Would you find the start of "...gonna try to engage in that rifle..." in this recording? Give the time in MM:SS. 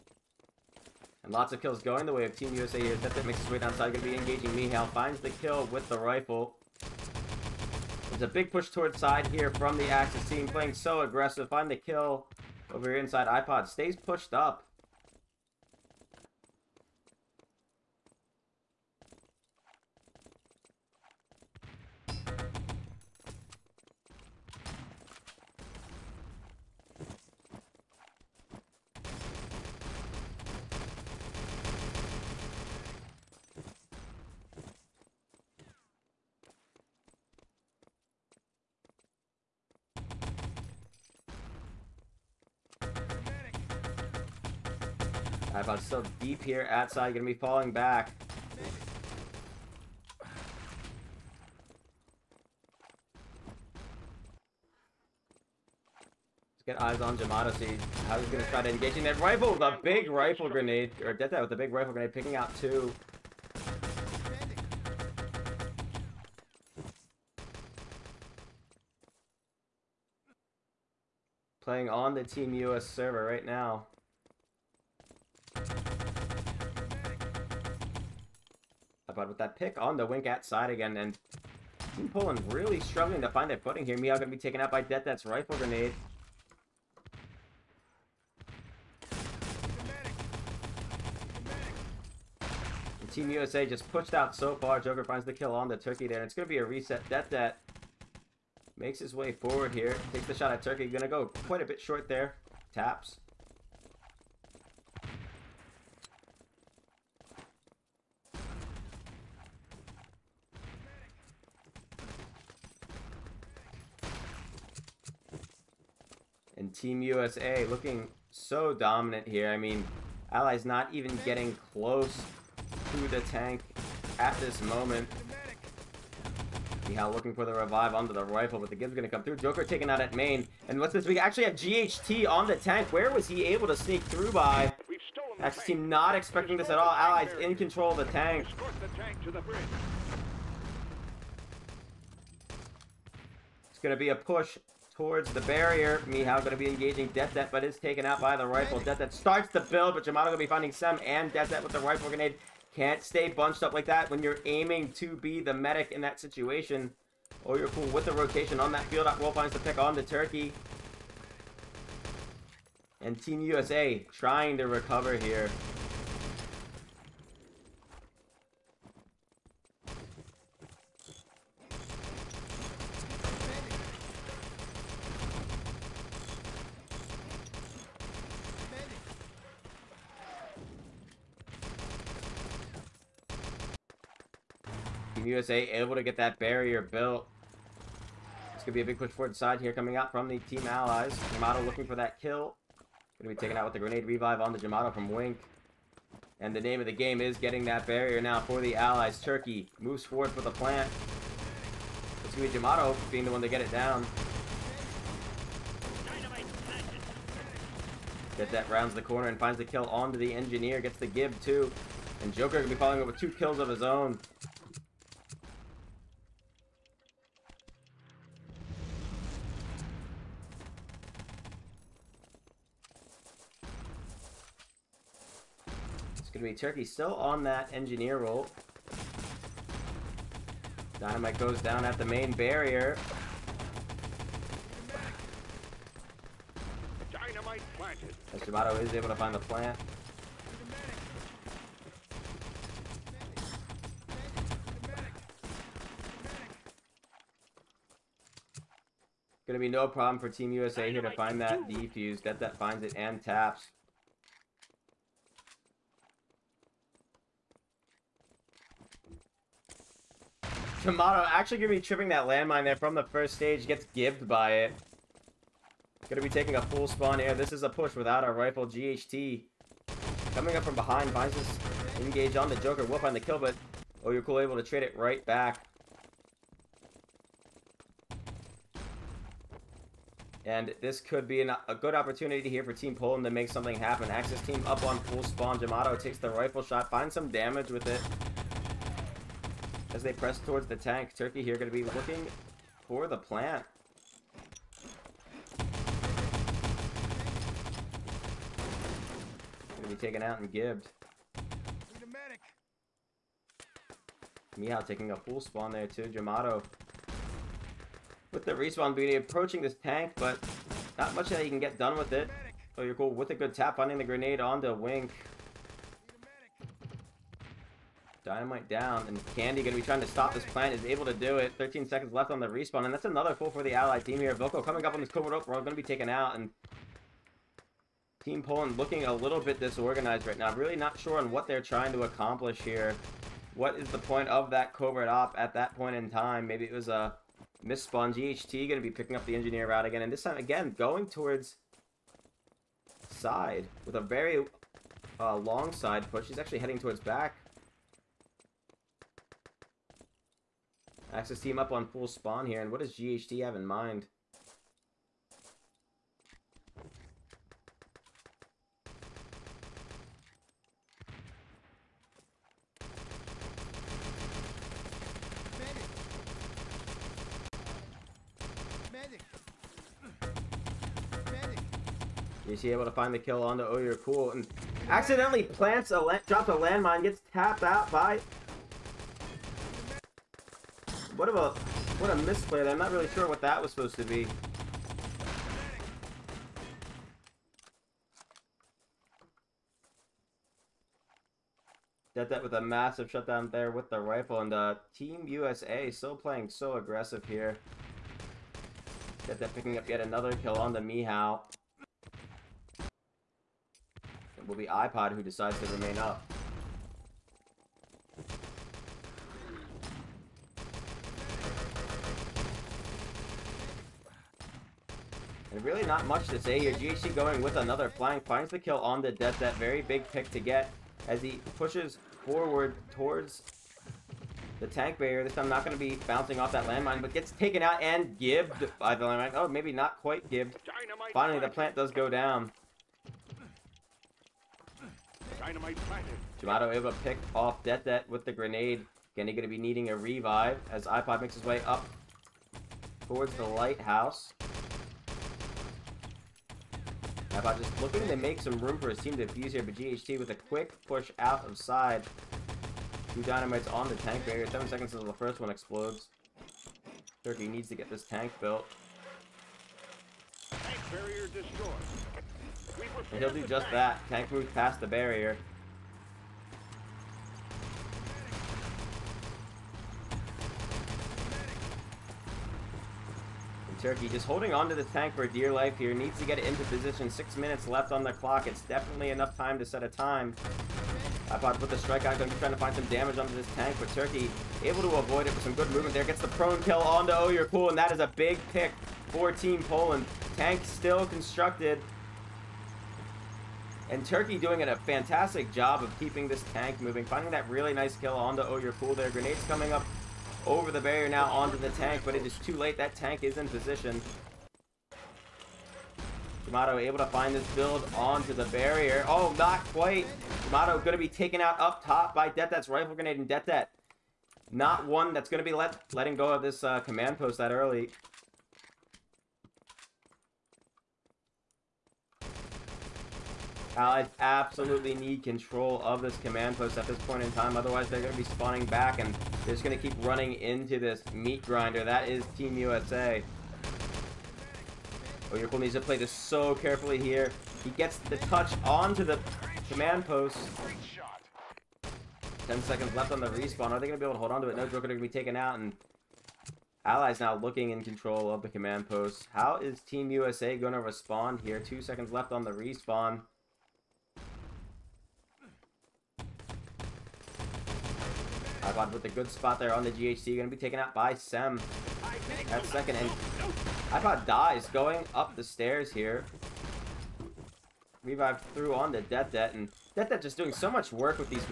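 00:58.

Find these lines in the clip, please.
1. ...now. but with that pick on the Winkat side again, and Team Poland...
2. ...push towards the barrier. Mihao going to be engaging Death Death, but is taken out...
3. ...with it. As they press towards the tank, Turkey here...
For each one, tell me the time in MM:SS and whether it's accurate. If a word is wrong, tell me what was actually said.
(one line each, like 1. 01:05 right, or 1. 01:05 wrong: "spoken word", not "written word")
1. 01:13 right
2. 02:24 right
3. 04:47 right.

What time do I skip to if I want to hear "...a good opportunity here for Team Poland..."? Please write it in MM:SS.
04:41.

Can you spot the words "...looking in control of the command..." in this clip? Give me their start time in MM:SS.
09:07.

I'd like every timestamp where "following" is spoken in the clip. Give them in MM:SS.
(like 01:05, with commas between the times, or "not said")
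03:32.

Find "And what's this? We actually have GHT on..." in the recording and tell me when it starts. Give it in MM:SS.
02:10.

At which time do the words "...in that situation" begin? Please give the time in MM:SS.
02:35.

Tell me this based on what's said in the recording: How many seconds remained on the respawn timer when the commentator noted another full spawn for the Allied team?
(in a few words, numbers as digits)
13.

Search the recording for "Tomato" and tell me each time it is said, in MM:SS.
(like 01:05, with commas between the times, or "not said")
04:20, 07:16.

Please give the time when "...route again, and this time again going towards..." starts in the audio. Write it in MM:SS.
05:39.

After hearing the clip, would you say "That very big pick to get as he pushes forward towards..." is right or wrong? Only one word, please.
right.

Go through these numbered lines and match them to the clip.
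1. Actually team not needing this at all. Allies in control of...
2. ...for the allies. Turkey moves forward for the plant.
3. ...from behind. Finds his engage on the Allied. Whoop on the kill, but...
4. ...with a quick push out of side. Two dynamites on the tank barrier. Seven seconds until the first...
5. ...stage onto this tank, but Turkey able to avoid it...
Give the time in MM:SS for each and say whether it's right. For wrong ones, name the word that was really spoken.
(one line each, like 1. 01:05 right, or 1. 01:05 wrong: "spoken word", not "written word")
1. 02:15 wrong: "expecting", not "needing"
2. 03:18 right
3. 04:30 wrong: "Joker", not "Allied"
4. 07:30 right
5. 08:02 wrong: "damage", not "stage".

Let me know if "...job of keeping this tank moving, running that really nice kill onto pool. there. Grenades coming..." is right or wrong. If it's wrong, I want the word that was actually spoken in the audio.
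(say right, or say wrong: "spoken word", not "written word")
wrong: "finding", not "running".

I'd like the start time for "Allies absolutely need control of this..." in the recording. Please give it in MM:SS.
08:43.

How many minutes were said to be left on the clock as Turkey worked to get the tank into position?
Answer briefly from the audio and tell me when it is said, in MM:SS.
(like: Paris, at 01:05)
6, at 07:57.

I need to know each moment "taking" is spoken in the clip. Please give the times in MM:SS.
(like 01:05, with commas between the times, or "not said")
04:26, 05:04.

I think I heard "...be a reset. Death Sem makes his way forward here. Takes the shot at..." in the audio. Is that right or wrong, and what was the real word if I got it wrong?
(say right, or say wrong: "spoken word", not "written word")
wrong: "That", not "Sem".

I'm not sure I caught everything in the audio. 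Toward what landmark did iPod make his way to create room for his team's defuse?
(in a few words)
the lighthouse.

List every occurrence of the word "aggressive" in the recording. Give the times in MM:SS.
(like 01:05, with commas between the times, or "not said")
00:11, 06:36.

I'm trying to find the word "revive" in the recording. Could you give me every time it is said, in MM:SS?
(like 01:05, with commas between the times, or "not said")
02:07, 03:14, 07:19, 09:28.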